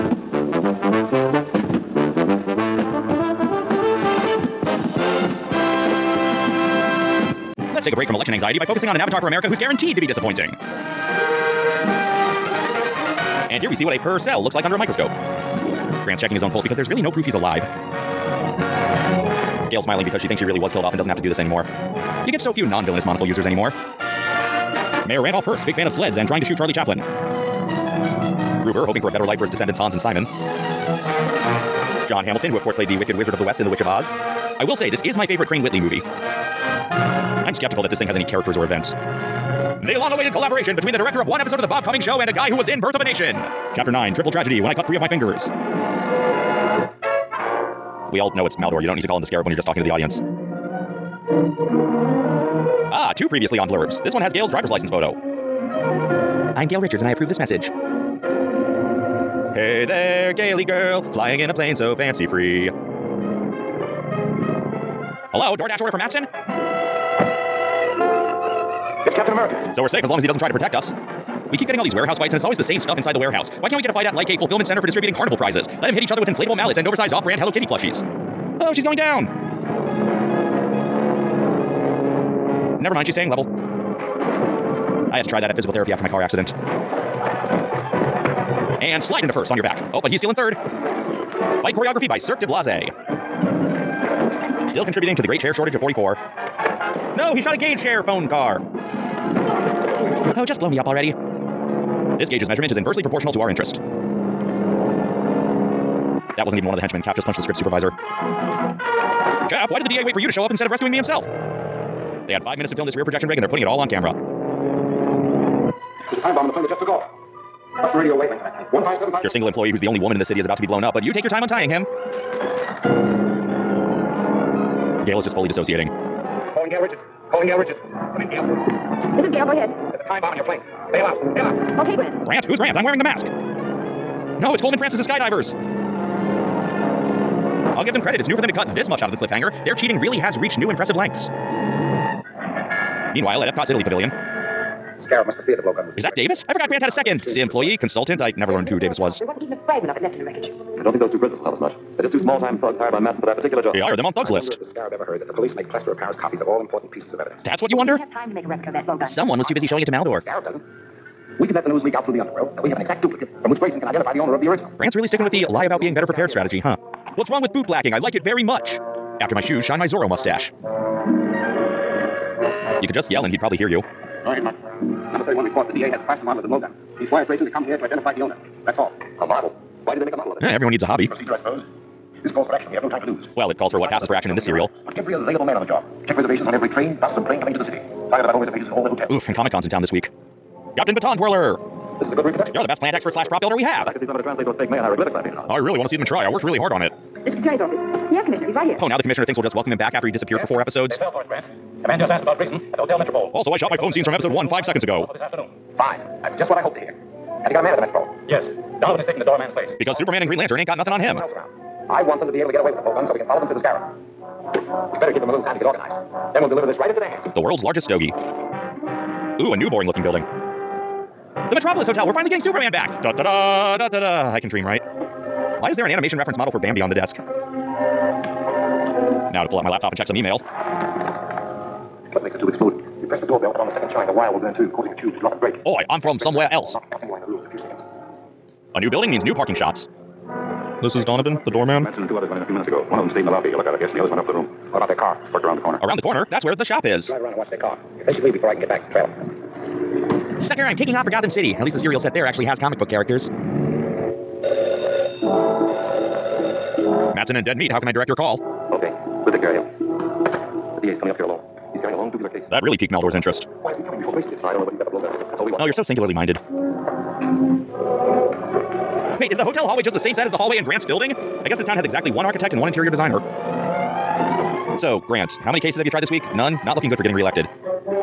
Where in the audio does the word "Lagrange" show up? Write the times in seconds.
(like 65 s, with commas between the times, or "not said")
not said.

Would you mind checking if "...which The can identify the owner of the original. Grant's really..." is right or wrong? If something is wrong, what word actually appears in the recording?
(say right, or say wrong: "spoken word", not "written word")
wrong: "Grayson", not "The".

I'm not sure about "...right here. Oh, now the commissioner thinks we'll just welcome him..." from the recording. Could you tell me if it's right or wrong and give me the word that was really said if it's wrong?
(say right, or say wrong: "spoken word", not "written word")
right.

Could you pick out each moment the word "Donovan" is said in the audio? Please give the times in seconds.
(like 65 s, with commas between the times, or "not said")
208 s, 241 s.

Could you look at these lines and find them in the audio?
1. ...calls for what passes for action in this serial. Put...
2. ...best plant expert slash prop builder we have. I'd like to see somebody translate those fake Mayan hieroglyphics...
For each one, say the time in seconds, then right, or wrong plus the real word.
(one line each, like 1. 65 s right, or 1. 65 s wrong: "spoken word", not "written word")
1. 183 s right
2. 192 s right.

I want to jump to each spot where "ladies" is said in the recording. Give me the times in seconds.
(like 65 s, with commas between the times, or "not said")
not said.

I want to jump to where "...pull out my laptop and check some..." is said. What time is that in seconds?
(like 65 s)
229 s.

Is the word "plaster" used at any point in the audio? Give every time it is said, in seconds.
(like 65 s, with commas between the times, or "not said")
155 s, 176 s.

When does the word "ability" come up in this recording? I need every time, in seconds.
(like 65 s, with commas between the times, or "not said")
not said.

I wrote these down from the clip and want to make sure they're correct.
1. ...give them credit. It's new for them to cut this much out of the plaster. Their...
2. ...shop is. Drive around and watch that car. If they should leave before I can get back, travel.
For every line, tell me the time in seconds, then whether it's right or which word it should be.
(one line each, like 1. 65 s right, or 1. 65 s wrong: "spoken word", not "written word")
1. 137 s wrong: "cliffhanger", not "plaster"
2. 246 s right.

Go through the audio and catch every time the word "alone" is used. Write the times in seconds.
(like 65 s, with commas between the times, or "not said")
261 s.